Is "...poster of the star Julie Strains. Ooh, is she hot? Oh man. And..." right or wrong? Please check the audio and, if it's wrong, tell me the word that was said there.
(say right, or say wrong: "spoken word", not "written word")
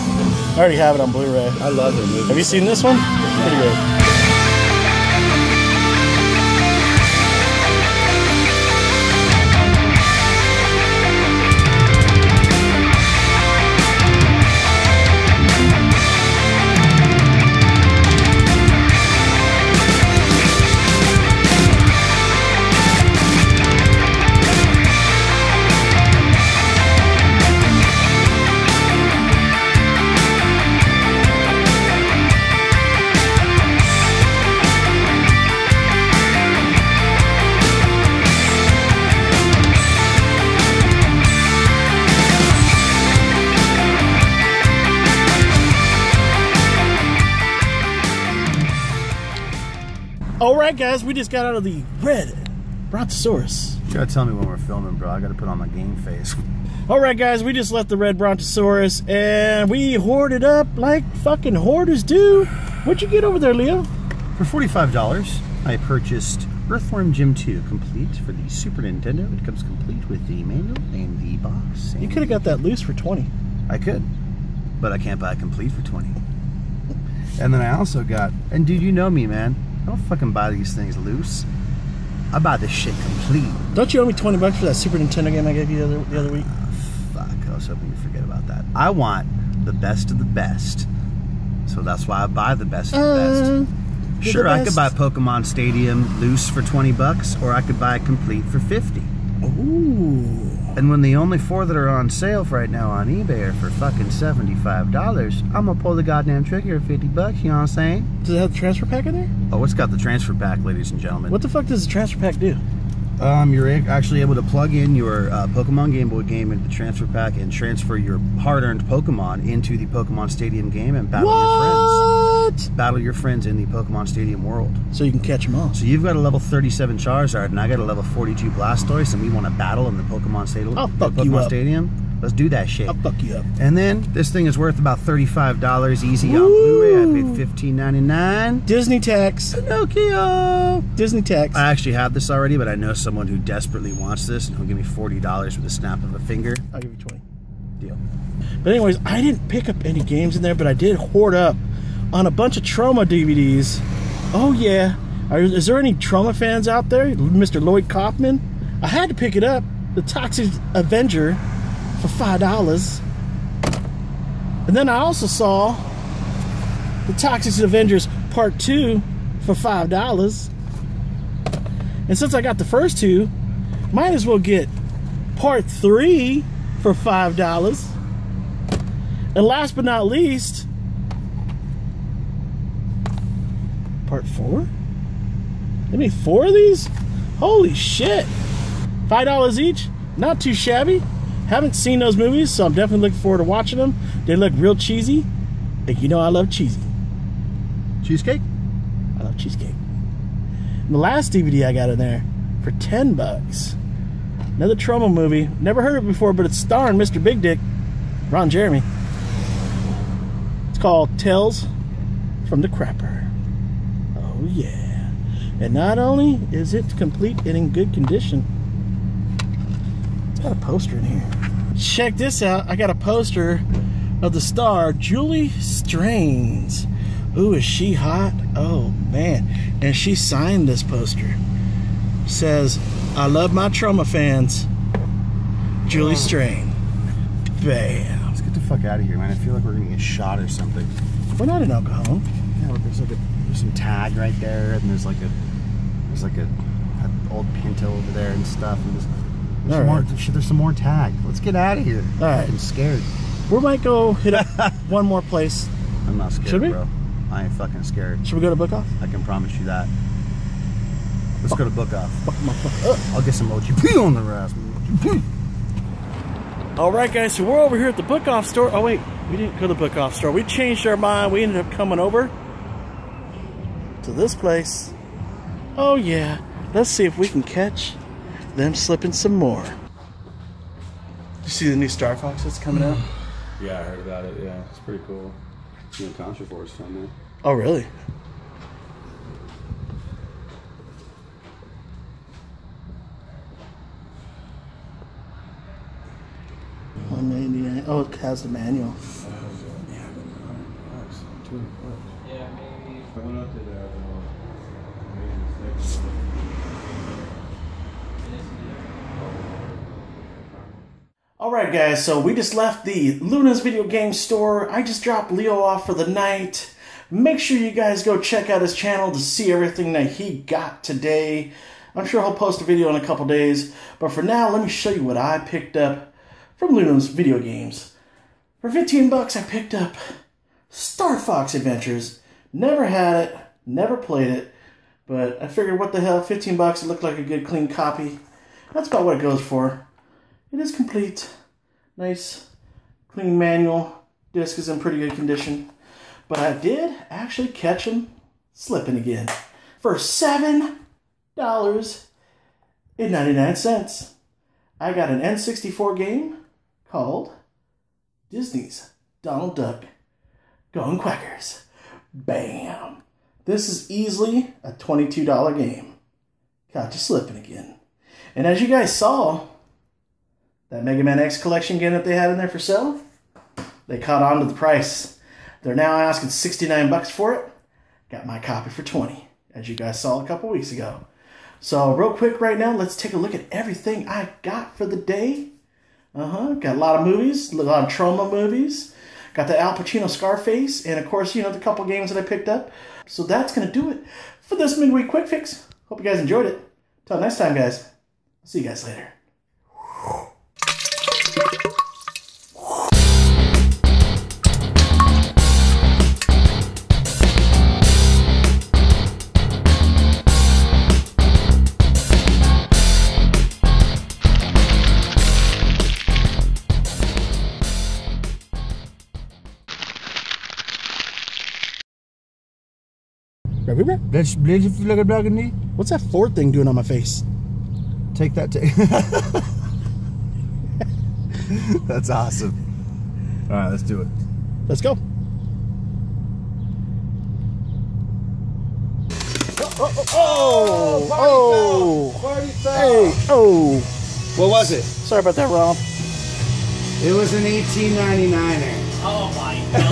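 right.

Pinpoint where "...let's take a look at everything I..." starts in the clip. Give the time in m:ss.
6:22.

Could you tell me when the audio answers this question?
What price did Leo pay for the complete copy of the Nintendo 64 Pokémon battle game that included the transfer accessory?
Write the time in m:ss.
1:46.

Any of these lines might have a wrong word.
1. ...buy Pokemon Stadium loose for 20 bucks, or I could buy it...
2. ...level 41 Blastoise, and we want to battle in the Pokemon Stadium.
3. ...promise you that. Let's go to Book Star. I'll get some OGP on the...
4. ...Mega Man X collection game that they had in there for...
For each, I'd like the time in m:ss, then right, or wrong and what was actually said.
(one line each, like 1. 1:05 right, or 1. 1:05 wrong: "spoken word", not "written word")
1. 1:34 right
2. 2:07 wrong: "42", not "41"
3. 4:19 wrong: "Off", not "Star"
4. 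6:10 right.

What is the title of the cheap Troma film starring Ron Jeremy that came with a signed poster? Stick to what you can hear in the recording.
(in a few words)
Tales from the Crapper.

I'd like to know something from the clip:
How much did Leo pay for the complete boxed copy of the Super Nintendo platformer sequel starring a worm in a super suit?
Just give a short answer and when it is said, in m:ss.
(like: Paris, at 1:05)
$45, at 1:04.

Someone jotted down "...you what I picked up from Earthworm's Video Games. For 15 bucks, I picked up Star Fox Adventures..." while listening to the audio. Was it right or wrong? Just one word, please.
wrong.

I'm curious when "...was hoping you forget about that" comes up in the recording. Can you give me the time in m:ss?
1:27.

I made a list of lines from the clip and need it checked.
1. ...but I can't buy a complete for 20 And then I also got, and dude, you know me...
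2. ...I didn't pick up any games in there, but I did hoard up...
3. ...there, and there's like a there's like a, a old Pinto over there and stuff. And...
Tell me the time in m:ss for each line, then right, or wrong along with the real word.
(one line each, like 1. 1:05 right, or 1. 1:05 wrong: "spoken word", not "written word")
1. 1:14 right
2. 2:29 right
3. 4:04 right.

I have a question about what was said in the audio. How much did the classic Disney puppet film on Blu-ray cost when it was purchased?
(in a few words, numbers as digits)
$15.99.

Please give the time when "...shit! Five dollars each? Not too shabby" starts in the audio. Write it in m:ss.
3:07.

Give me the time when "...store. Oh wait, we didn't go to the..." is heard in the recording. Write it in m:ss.
4:28.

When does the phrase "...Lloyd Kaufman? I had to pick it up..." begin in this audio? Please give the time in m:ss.
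2:37.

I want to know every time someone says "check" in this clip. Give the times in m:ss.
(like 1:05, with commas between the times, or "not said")
3:41, 5:18.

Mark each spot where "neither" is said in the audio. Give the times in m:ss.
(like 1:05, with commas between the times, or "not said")
not said.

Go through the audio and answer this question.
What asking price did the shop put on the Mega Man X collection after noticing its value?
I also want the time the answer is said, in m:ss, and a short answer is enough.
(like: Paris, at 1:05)
$69, at 6:16.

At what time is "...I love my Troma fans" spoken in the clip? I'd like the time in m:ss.
3:53.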